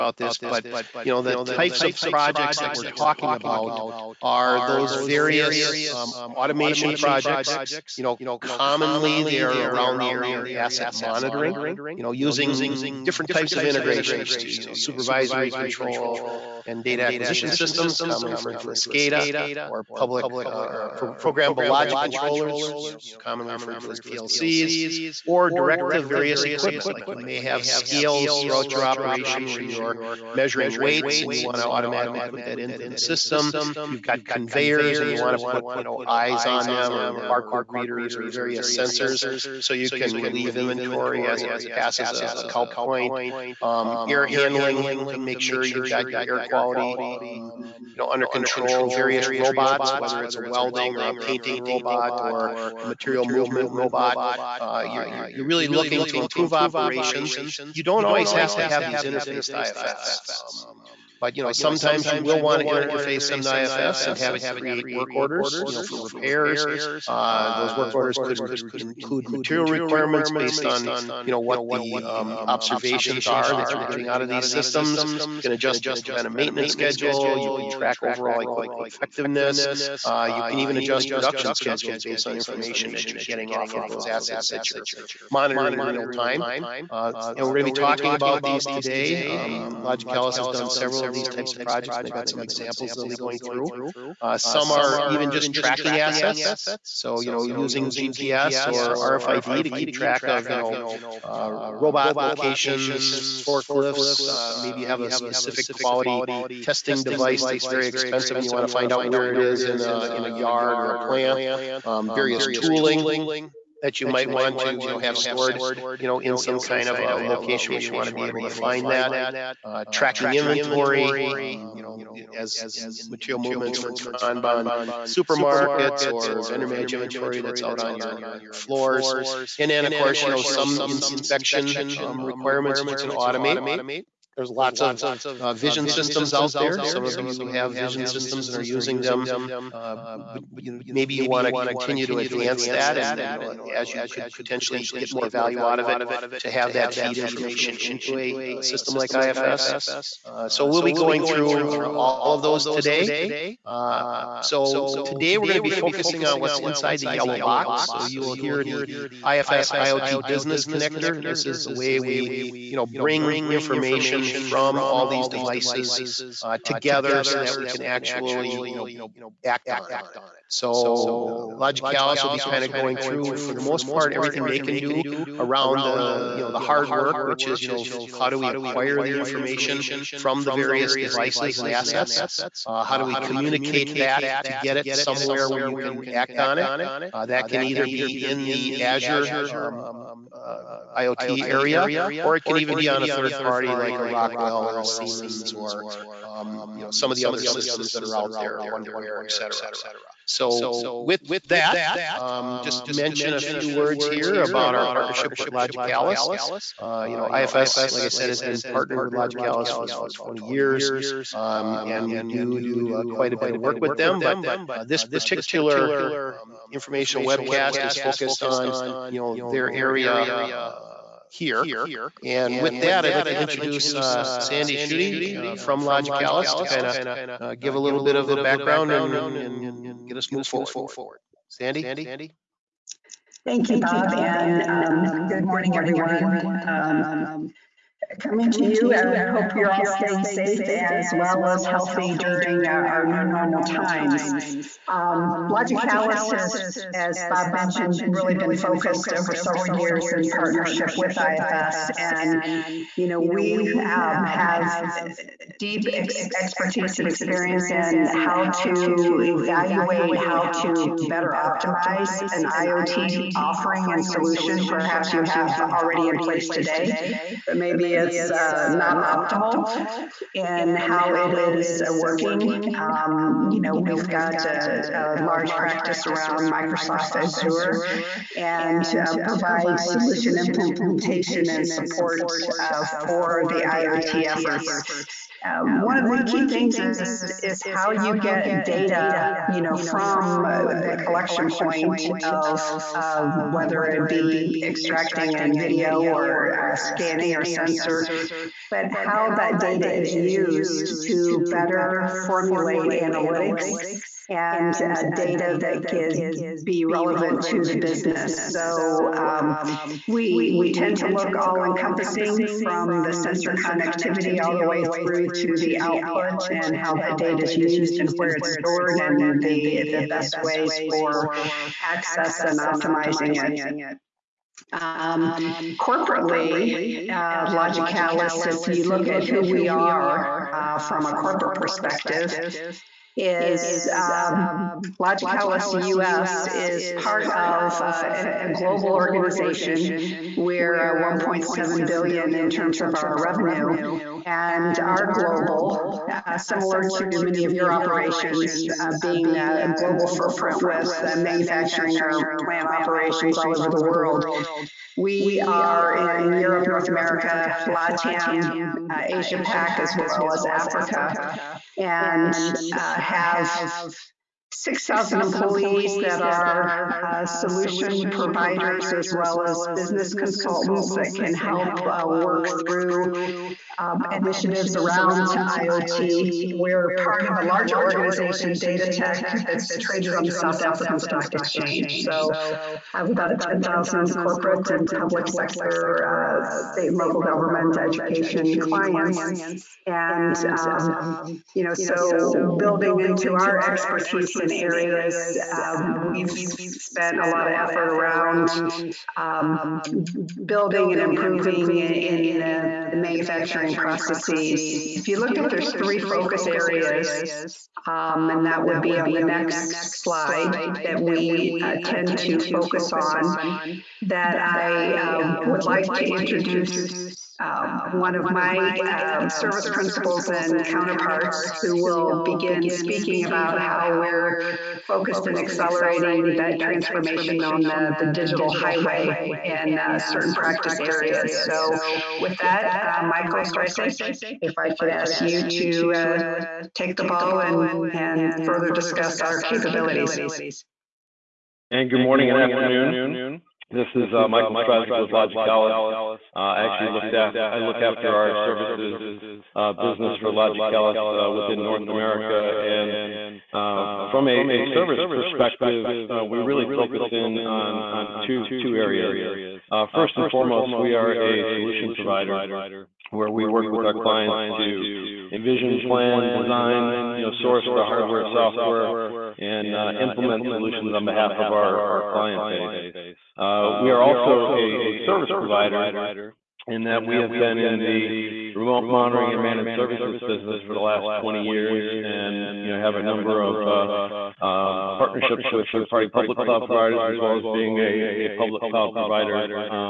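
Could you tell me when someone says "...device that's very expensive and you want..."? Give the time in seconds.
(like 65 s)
107 s.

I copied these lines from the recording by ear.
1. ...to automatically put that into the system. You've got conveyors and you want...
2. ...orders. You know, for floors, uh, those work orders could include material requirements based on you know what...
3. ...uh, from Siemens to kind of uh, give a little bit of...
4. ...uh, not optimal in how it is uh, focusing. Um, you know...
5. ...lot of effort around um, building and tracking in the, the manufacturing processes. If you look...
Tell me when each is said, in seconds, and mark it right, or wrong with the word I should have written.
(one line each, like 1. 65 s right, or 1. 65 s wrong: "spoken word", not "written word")
1. 31 s right
2. 65 s wrong: "repairs", not "floors"
3. 225 s wrong: "Logicalis", not "Siemens"
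4. 268 s wrong: "working", not "focusing"
5. 397 s wrong: "improving", not "tracking".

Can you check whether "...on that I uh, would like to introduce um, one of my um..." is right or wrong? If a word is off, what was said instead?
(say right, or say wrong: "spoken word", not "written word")
right.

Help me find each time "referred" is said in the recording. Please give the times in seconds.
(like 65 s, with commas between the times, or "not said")
18 s, 23 s.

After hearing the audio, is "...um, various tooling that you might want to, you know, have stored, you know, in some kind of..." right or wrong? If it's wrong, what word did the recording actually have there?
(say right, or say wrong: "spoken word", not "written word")
right.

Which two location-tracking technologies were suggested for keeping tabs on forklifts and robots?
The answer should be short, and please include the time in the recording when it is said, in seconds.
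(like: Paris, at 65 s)
GPS or RFID, at 97 s.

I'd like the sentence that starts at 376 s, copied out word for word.
We're part of a larger organization, Datatec, that's traded on the South African Stock Exchange.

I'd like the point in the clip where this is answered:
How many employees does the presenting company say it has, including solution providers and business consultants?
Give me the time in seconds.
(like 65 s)
364 s.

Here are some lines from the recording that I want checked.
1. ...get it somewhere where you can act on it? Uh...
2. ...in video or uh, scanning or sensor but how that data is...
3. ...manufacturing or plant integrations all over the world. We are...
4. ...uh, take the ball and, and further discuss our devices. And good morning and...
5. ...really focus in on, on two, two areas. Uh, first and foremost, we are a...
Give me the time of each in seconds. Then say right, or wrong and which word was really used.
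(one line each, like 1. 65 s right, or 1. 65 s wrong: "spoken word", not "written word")
1. 184 s right
2. 295 s right
3. 351 s wrong: "operations", not "integrations"
4. 435 s wrong: "capabilities", not "devices"
5. 456 s right.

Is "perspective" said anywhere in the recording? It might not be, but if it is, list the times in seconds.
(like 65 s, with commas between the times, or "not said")
331 s, 455 s.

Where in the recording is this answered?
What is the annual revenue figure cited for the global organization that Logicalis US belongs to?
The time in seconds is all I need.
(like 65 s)
340 s.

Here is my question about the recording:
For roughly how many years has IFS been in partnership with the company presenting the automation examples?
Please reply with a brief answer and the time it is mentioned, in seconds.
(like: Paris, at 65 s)
20 years, at 209 s.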